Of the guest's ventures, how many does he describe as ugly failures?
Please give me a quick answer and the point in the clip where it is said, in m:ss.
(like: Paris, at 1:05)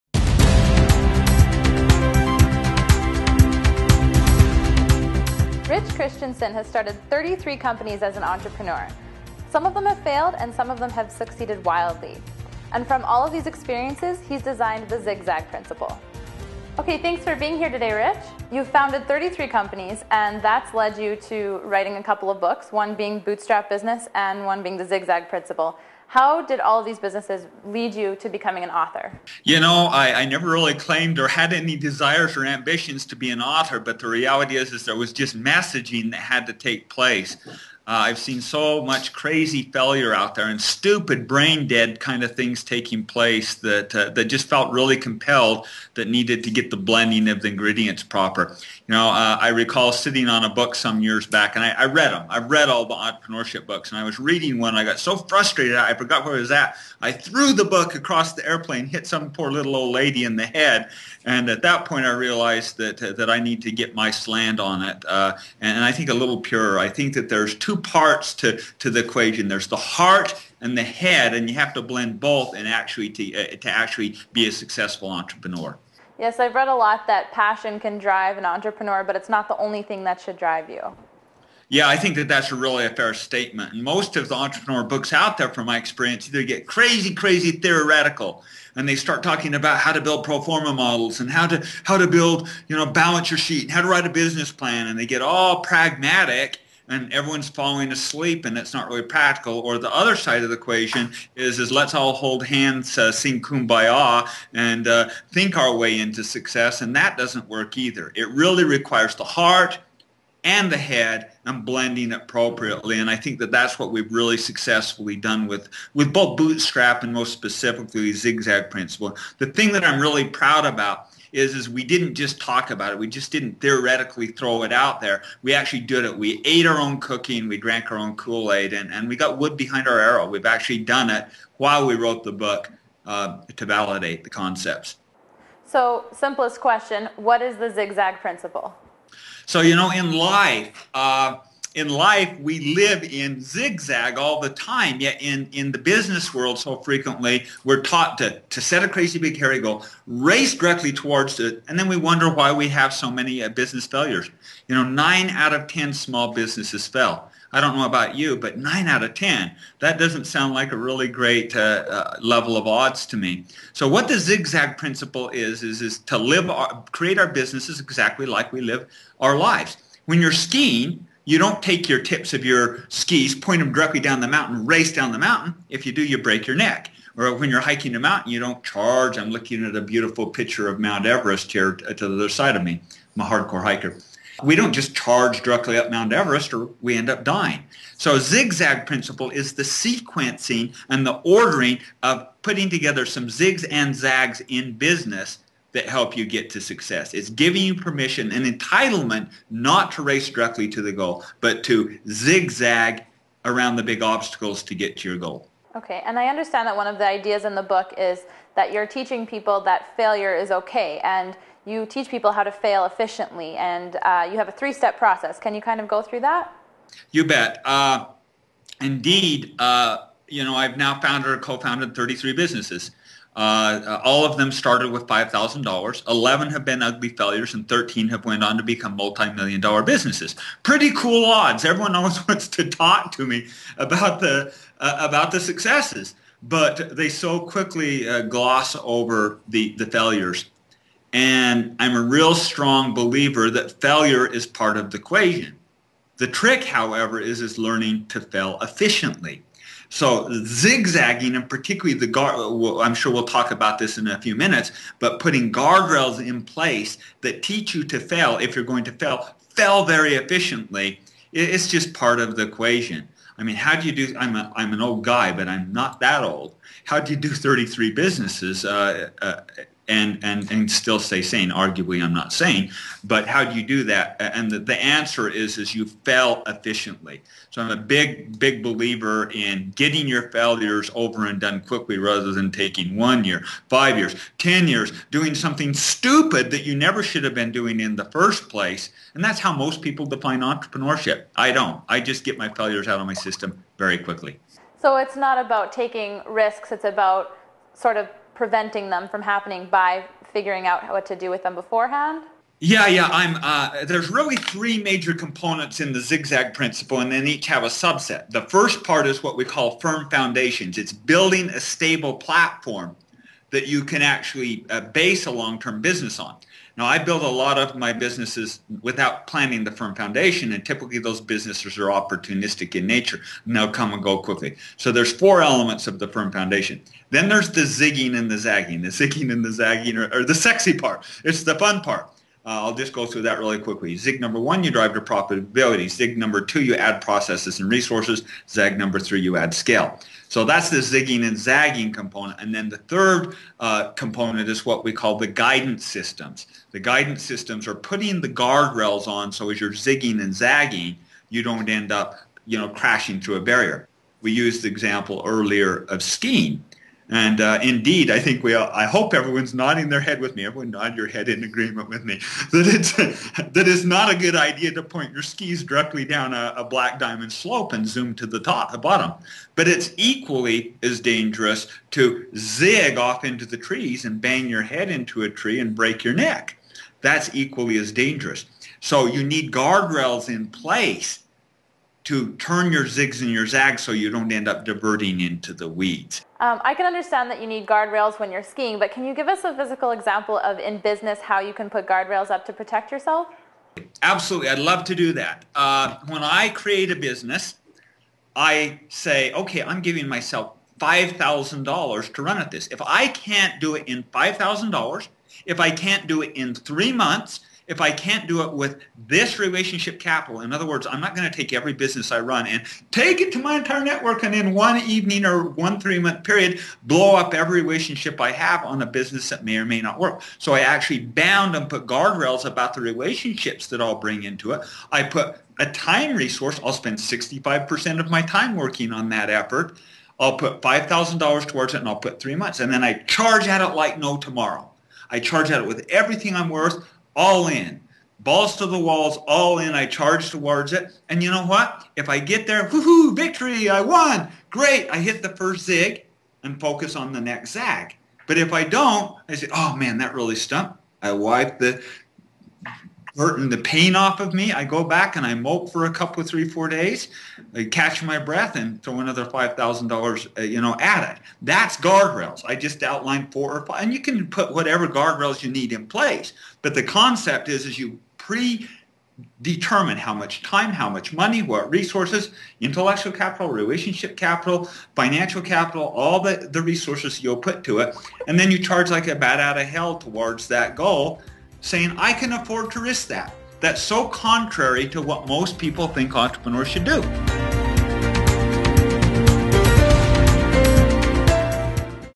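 11, at 3:46.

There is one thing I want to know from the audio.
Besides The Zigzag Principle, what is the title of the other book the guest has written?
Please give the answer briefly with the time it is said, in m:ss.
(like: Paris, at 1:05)
Bootstrap Business, at 0:23.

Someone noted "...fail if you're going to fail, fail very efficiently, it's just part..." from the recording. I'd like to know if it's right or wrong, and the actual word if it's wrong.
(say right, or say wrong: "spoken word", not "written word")
right.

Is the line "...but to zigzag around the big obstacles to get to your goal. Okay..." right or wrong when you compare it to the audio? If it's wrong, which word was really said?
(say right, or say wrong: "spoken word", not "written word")
right.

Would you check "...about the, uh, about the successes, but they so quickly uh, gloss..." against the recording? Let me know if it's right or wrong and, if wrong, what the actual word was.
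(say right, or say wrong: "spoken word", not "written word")
right.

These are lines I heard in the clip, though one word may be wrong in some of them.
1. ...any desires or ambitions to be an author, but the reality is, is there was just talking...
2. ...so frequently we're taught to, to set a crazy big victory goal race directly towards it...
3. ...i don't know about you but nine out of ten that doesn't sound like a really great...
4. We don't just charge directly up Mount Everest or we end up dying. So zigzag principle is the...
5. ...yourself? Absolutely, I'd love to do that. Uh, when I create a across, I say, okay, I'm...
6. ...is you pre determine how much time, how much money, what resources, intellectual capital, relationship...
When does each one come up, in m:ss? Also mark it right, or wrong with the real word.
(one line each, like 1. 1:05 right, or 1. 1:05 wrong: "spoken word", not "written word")
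1. 0:31 wrong: "messaging", not "talking"
2. 2:26 wrong: "hairy", not "victory"
3. 2:37 right
4. 3:04 right
5. 6:32 wrong: "business", not "across"
6. 7:47 right.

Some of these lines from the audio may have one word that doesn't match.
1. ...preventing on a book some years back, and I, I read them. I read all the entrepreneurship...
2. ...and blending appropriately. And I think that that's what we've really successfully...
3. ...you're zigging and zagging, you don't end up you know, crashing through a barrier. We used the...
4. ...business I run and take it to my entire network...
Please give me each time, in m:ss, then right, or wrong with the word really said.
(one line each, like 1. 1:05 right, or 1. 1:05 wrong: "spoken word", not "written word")
1. 0:49 wrong: "sitting", not "preventing"
2. 1:51 right
3. 5:49 right
4. 6:51 right.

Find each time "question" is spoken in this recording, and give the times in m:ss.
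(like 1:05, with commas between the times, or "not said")
2:16.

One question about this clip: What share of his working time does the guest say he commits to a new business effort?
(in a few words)
65%.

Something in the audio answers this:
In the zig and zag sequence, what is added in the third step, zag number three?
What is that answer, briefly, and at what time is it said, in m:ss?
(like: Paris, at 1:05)
scale, at 5:39.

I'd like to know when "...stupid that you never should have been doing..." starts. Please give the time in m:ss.
4:45.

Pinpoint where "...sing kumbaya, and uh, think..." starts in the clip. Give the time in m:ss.
1:43.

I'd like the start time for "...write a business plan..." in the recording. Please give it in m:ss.
1:33.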